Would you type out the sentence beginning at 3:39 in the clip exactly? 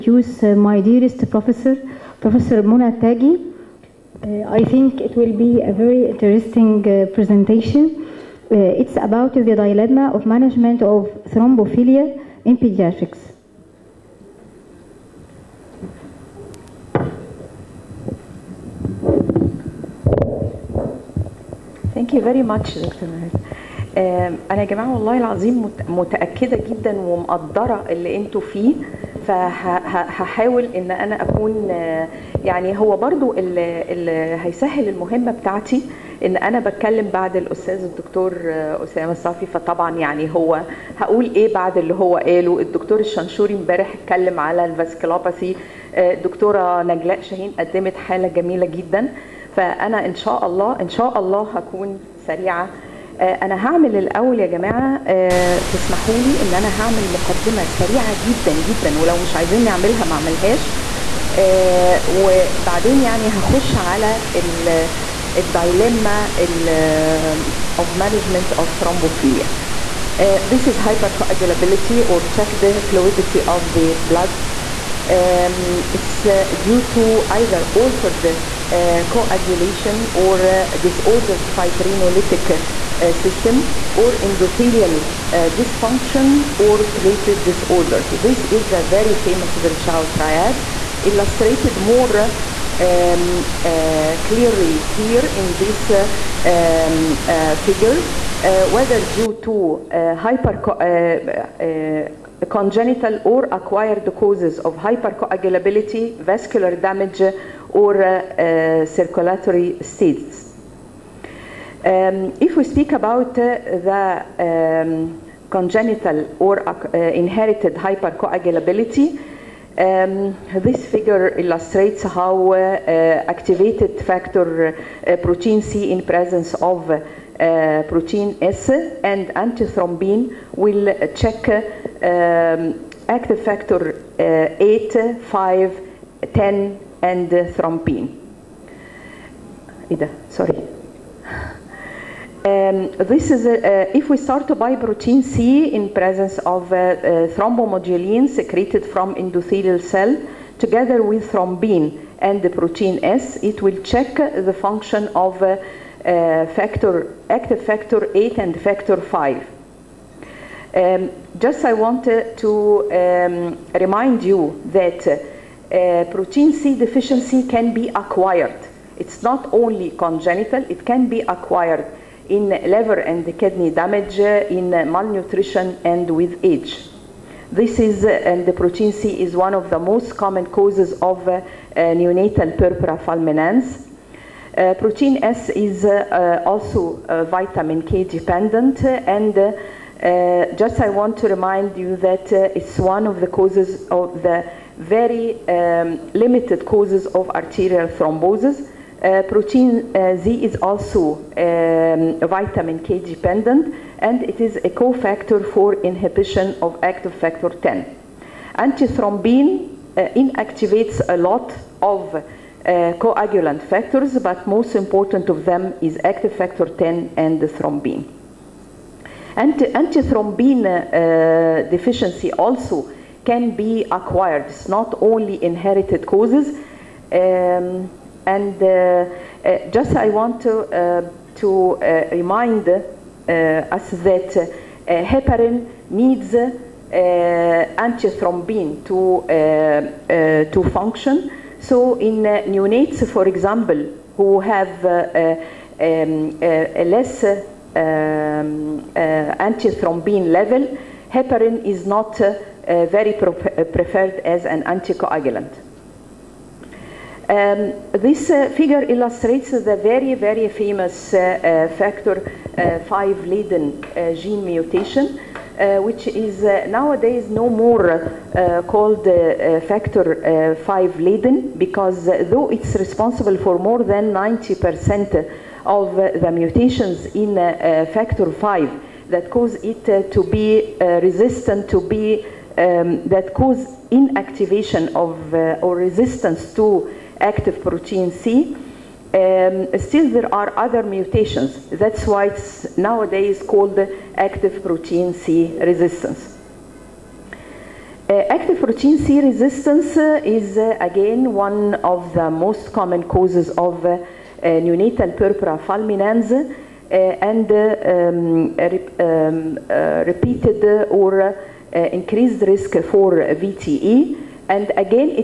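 antithrombin uh, deficiency also can be acquired.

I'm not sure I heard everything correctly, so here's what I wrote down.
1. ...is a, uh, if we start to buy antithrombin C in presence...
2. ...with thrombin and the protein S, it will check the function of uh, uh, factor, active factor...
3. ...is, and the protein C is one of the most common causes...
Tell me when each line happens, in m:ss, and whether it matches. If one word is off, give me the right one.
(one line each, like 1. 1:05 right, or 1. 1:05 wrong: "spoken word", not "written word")
1. 2:23 wrong: "protein", not "antithrombin"
2. 2:31 right
3. 2:57 right.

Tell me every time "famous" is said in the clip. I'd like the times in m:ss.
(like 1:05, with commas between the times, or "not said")
1:29, 4:20.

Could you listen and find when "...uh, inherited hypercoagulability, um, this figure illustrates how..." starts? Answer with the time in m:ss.
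1:56.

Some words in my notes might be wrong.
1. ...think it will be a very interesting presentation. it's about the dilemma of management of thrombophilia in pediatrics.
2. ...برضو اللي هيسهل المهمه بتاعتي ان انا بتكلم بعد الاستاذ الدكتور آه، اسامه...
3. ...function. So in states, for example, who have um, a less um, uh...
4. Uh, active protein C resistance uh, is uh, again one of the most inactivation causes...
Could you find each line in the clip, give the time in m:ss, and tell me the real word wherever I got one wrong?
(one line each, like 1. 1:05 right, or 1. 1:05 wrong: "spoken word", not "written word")
1. 0:04 right
2. 0:32 right
3. 4:00 wrong: "neonates", not "states"
4. 4:58 wrong: "common", not "inactivation".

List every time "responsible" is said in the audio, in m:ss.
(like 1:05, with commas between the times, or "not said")
4:32.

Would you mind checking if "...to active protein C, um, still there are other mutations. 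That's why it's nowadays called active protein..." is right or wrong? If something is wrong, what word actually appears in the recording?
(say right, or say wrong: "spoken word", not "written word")
right.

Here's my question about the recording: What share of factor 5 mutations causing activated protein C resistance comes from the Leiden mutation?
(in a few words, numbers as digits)
more than 90%.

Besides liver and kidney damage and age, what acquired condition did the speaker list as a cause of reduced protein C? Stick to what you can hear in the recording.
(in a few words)
malnutrition.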